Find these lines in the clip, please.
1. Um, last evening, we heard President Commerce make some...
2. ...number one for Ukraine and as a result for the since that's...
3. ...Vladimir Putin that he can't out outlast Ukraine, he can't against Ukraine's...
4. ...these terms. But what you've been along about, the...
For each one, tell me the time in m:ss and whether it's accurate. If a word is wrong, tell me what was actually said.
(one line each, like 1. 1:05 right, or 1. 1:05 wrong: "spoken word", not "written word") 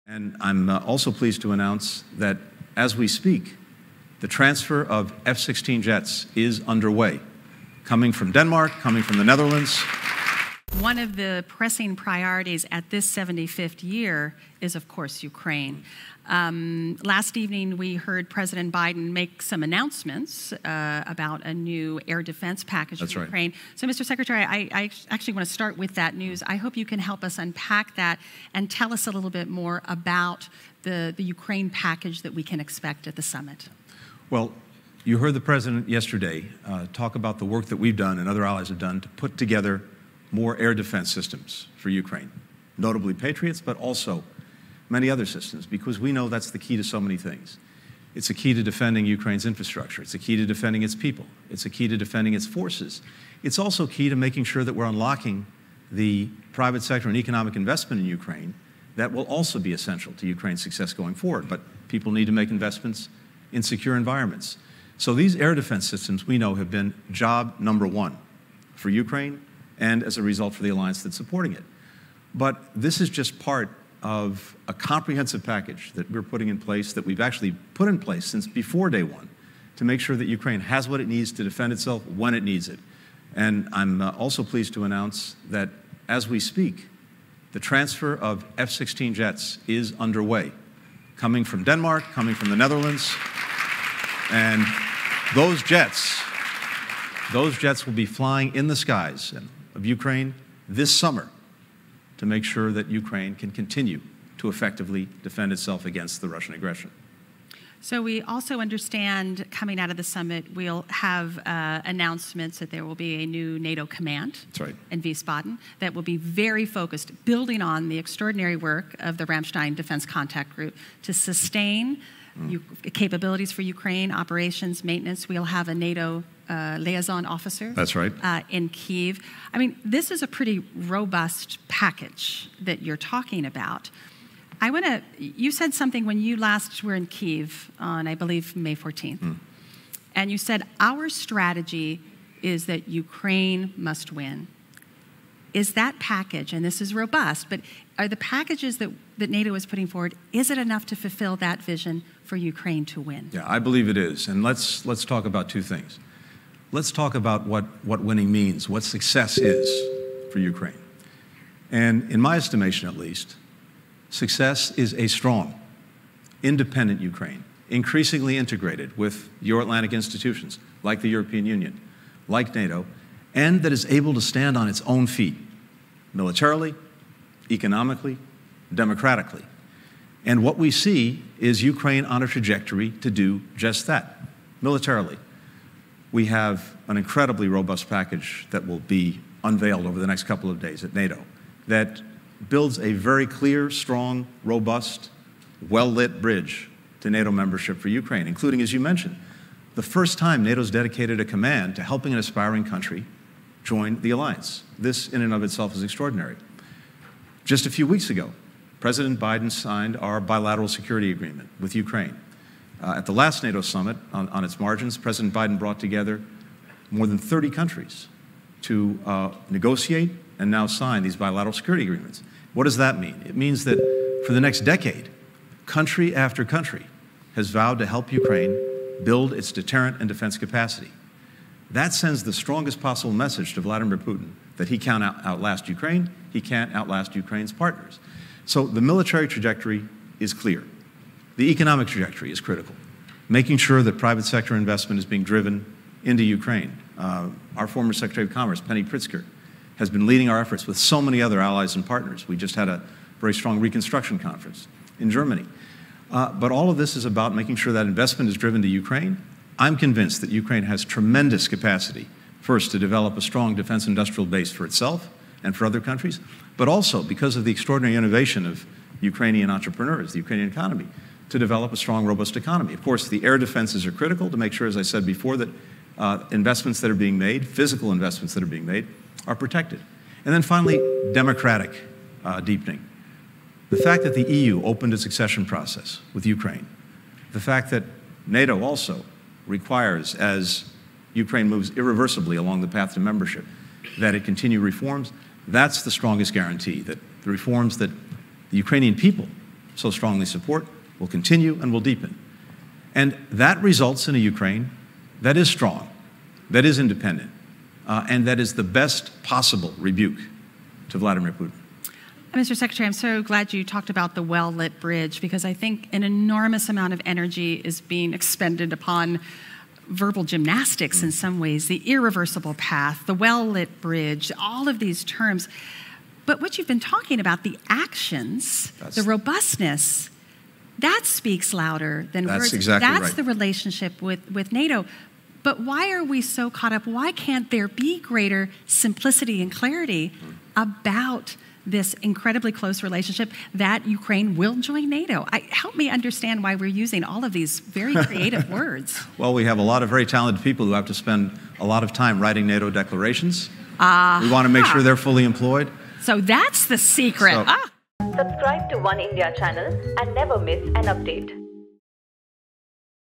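1. 0:16 wrong: "Biden", not "Commerce"
2. 1:07 wrong: "alliance", not "since"
3. 3:53 wrong: "outlast", not "against"
4. 5:24 wrong: "talking", not "along".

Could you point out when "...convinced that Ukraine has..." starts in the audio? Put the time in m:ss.
4:19.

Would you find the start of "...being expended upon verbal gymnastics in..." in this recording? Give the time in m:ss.
5:17.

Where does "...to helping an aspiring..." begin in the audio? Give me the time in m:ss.
3:21.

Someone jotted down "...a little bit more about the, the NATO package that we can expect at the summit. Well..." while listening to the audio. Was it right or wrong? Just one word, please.
wrong.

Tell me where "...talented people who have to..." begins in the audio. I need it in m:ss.
5:50.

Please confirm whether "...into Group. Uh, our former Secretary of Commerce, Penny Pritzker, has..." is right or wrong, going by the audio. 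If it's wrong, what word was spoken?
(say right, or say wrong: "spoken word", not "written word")
wrong: "Ukraine", not "Group".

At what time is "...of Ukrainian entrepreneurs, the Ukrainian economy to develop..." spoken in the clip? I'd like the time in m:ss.
4:28.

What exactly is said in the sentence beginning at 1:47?
So we also understand coming out of the summit, we'll have uh, announcements that there will be a new NATO command right.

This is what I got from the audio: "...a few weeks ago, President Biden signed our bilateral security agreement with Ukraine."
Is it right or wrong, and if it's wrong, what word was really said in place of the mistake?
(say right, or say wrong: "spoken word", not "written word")
right.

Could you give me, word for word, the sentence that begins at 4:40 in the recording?
And then finally, democratic uh, deepening.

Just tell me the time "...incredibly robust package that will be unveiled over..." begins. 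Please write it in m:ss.
3:06.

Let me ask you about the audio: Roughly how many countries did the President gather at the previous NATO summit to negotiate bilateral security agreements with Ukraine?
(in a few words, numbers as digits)
More than 30.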